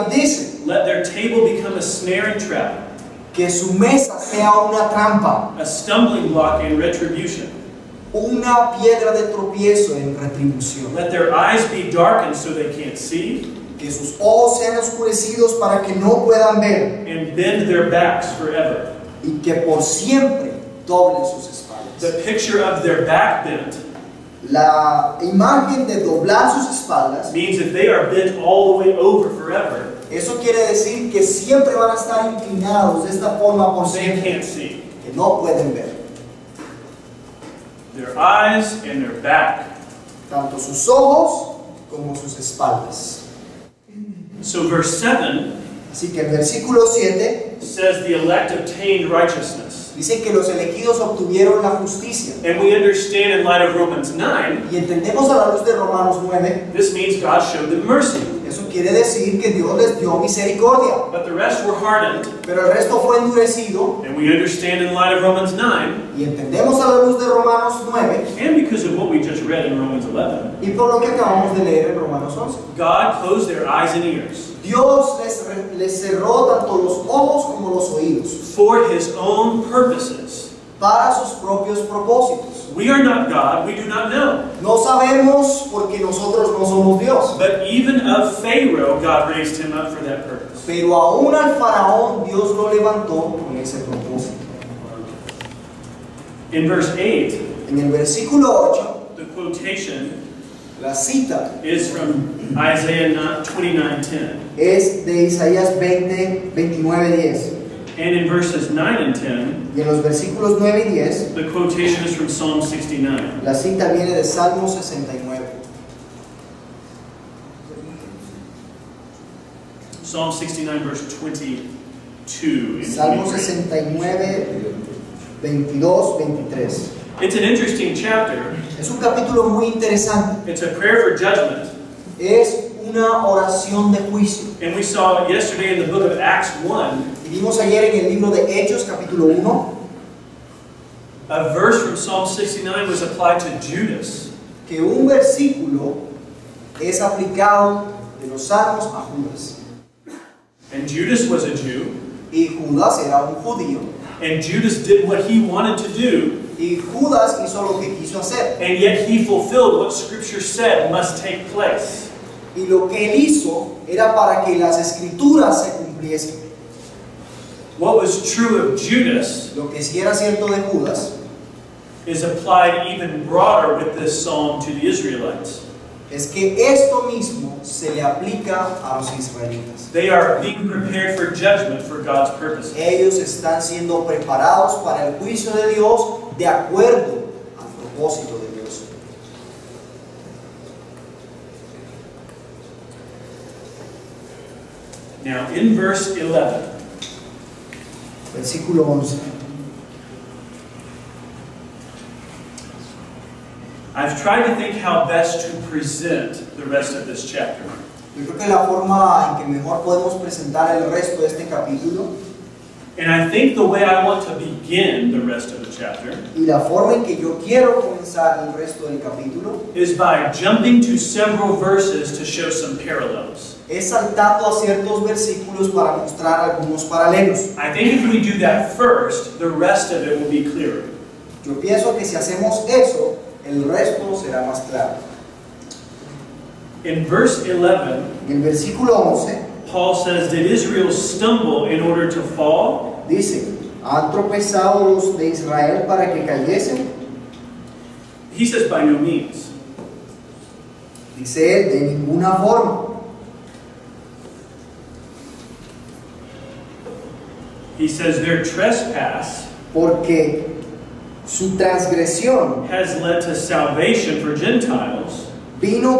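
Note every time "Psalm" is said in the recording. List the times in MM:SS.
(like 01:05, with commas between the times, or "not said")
01:52, 02:00, 02:21.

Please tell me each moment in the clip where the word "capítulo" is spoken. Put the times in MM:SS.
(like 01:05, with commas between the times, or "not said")
02:08, 02:18, 03:31, 03:38.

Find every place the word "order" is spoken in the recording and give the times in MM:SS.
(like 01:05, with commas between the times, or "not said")
04:01.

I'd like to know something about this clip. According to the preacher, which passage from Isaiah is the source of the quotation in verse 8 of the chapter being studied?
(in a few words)
Isaiah 29:10.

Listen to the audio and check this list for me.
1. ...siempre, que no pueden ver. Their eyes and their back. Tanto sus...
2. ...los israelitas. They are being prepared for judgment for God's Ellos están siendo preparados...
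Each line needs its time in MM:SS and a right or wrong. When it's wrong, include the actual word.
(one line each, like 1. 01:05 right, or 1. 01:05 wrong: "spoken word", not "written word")
1. 00:33 right
2. 02:58 right.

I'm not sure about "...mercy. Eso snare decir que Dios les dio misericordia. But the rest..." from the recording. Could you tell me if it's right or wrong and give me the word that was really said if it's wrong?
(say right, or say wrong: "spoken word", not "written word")
wrong: "quiere", not "snare".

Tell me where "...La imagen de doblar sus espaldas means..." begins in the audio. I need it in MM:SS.
00:24.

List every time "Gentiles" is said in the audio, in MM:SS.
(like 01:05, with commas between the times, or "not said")
04:24.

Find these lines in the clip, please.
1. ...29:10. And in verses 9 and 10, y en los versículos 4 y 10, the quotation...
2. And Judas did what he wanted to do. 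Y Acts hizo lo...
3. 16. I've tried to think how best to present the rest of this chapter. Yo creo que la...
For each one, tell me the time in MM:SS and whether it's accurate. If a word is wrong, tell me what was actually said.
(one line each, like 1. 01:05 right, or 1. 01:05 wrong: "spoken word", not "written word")
1. 01:46 wrong: "9", not "4"
2. 02:34 wrong: "Judas", not "Acts"
3. 03:18 wrong: "11", not "16".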